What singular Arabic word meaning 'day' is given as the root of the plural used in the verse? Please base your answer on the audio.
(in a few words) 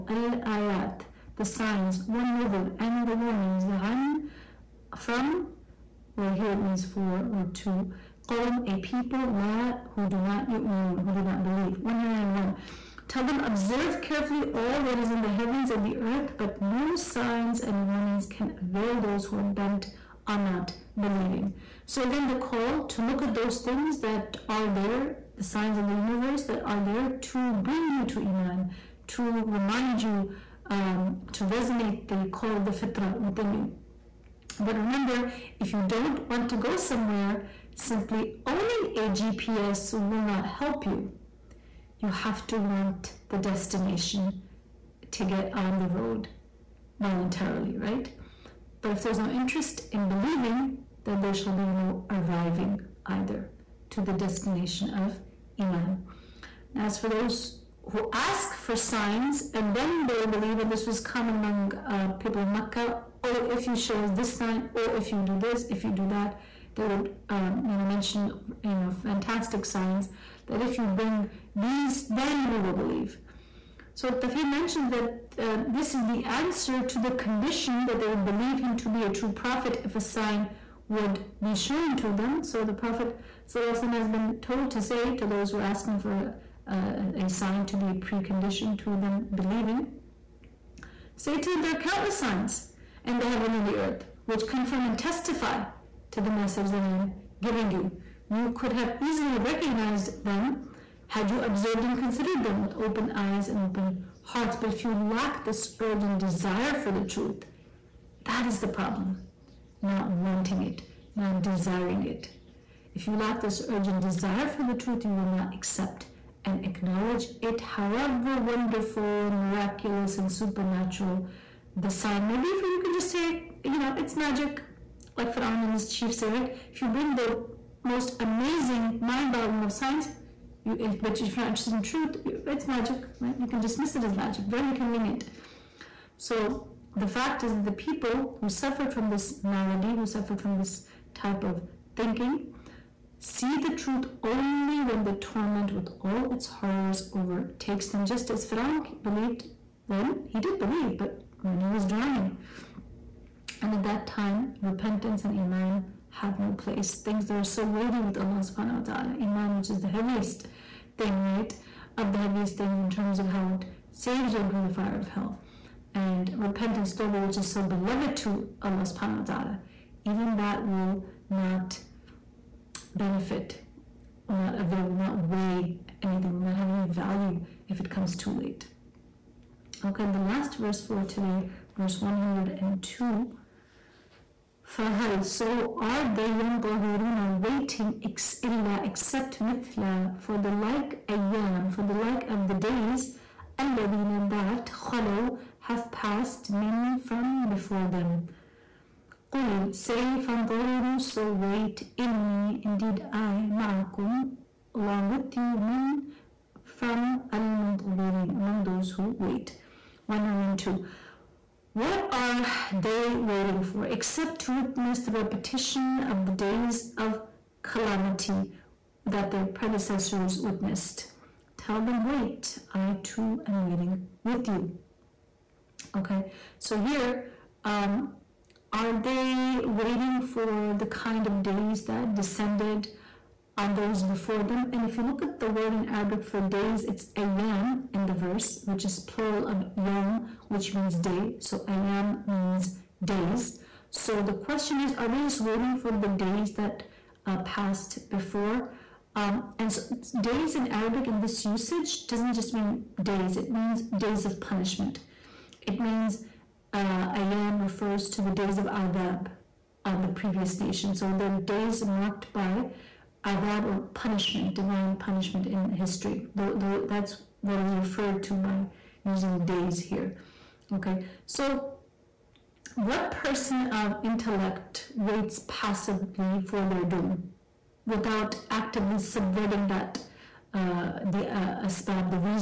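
yom.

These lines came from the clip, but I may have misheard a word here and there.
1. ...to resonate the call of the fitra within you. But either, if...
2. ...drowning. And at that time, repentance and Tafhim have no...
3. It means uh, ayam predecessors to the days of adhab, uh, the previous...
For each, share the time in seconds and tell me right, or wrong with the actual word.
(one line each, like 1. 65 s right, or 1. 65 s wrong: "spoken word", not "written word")
1. 31 s wrong: "remember", not "either"
2. 151 s wrong: "Iman", not "Tafhim"
3. 255 s wrong: "refers", not "predecessors".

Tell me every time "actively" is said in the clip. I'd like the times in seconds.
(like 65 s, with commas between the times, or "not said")
278 s.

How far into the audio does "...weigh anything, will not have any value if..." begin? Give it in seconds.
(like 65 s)
175 s.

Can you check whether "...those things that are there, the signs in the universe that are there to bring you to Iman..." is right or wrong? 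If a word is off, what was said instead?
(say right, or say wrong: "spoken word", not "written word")
right.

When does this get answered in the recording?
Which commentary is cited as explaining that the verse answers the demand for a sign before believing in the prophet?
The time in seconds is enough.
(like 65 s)
74 s.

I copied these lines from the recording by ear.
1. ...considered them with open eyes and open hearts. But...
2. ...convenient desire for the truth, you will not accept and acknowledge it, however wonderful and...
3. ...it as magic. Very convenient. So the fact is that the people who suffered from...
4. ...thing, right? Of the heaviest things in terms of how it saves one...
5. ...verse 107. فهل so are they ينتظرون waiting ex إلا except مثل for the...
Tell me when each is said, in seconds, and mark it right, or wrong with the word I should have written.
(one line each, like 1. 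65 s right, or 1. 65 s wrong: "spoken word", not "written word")
1. 101 s right
2. 113 s wrong: "urgent", not "convenient"
3. 133 s right
4. 160 s right
5. 181 s wrong: "102", not "107".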